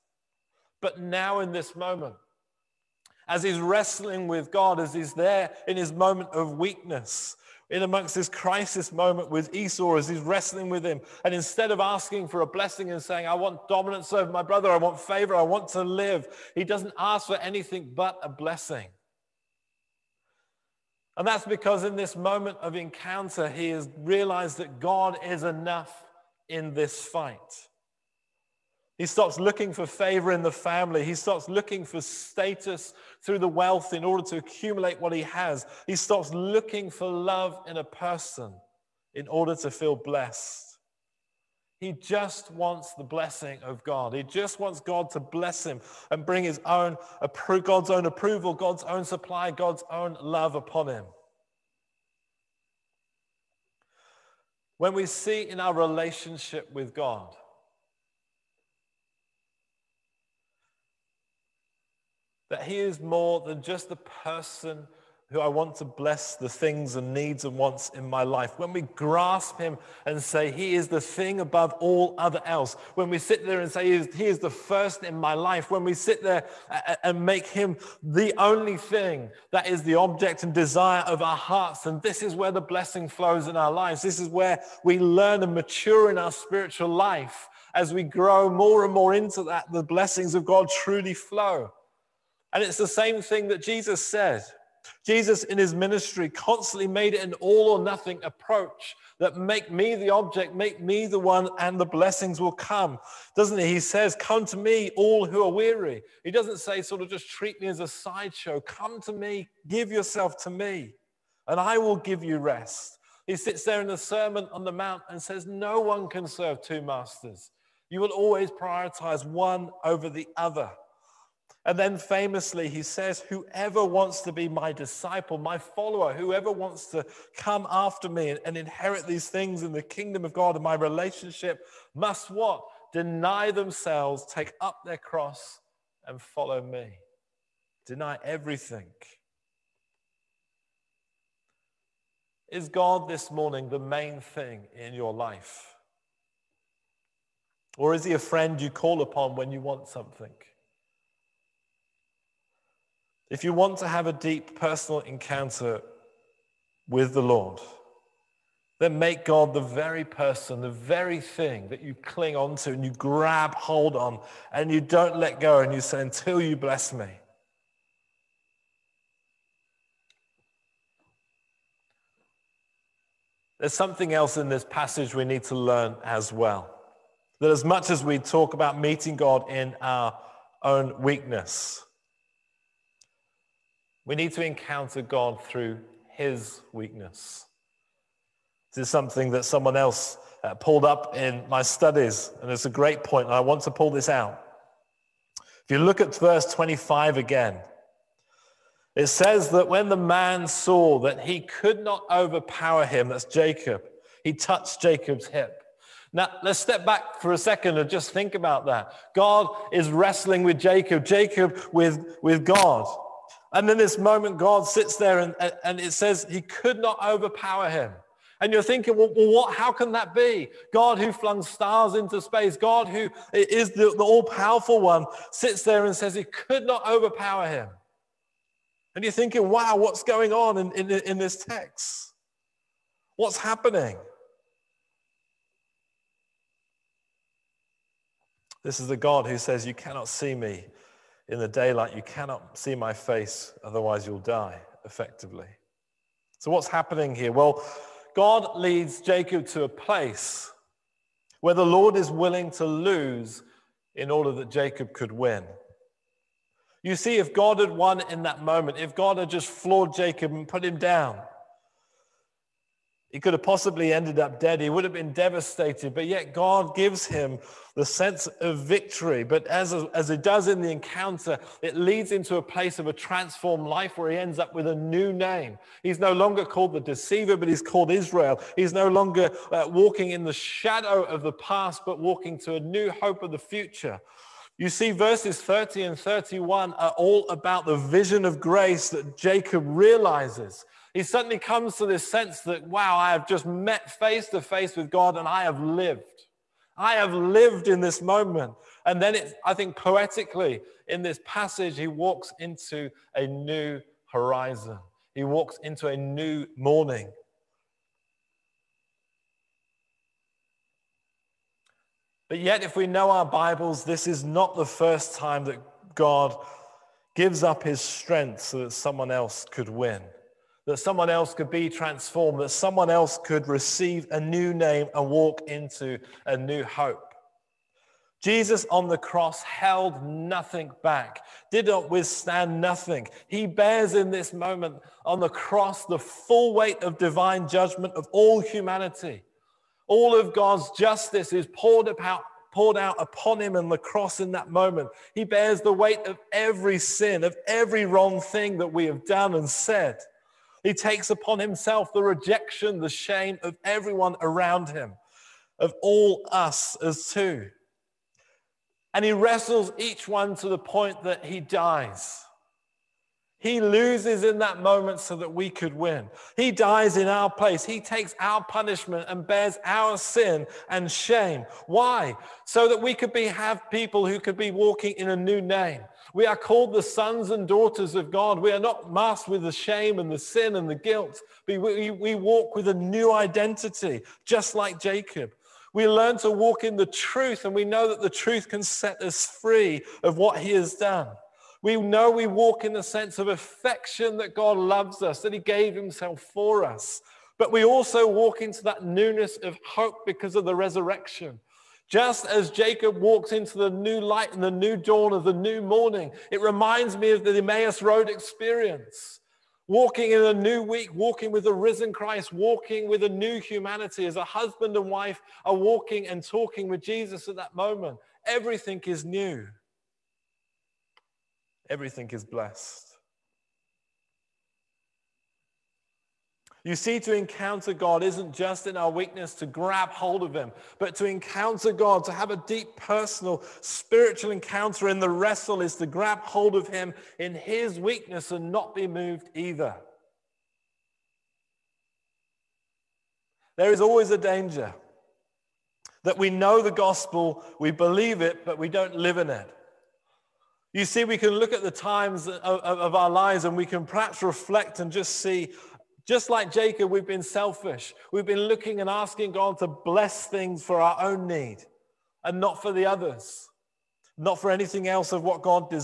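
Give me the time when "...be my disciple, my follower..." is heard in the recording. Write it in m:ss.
2:04.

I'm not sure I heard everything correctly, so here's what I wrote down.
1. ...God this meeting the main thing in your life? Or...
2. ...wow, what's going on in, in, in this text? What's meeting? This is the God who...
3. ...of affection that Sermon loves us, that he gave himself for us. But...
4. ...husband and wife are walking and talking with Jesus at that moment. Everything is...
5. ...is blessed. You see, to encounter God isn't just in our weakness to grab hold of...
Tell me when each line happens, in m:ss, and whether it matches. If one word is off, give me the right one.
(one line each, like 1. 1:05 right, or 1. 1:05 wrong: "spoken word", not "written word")
1. 2:22 wrong: "morning", not "meeting"
2. 3:49 wrong: "happening", not "meeting"
3. 6:33 wrong: "God", not "Sermon"
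4. 6:54 right
5. 7:02 right.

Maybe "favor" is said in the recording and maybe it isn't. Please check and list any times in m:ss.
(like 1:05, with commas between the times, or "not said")
0:14, 0:29.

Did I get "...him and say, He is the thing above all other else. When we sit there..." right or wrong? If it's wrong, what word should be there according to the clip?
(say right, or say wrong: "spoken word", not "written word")
right.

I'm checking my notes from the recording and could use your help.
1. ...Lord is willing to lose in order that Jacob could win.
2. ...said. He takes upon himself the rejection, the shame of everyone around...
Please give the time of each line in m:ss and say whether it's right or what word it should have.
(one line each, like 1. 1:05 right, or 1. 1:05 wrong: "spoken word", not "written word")
1. 4:11 right
2. 5:49 right.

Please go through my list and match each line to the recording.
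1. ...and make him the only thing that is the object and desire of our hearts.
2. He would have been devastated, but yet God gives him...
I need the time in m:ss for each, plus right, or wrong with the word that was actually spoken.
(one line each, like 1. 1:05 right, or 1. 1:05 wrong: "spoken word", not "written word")
1. 1:17 right
2. 4:24 right.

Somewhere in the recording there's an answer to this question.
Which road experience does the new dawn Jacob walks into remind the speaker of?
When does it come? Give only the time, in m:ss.
6:47.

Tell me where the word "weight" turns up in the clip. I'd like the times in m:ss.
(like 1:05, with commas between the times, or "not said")
5:36, 5:45.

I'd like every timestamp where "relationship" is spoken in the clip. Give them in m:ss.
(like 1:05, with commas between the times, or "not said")
0:55, 2:10.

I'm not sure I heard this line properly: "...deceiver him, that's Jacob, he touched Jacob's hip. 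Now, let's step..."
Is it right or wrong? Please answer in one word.
wrong.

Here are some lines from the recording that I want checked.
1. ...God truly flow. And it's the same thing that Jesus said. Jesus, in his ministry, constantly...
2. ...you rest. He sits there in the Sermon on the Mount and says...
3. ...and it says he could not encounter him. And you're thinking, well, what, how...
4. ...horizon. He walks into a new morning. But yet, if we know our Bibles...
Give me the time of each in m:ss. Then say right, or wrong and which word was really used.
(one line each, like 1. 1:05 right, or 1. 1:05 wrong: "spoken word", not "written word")
1. 1:30 right
2. 1:52 right
3. 3:35 wrong: "overpower", not "encounter"
4. 5:04 right.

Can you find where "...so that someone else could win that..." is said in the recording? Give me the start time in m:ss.
5:18.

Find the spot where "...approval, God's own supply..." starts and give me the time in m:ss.
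0:48.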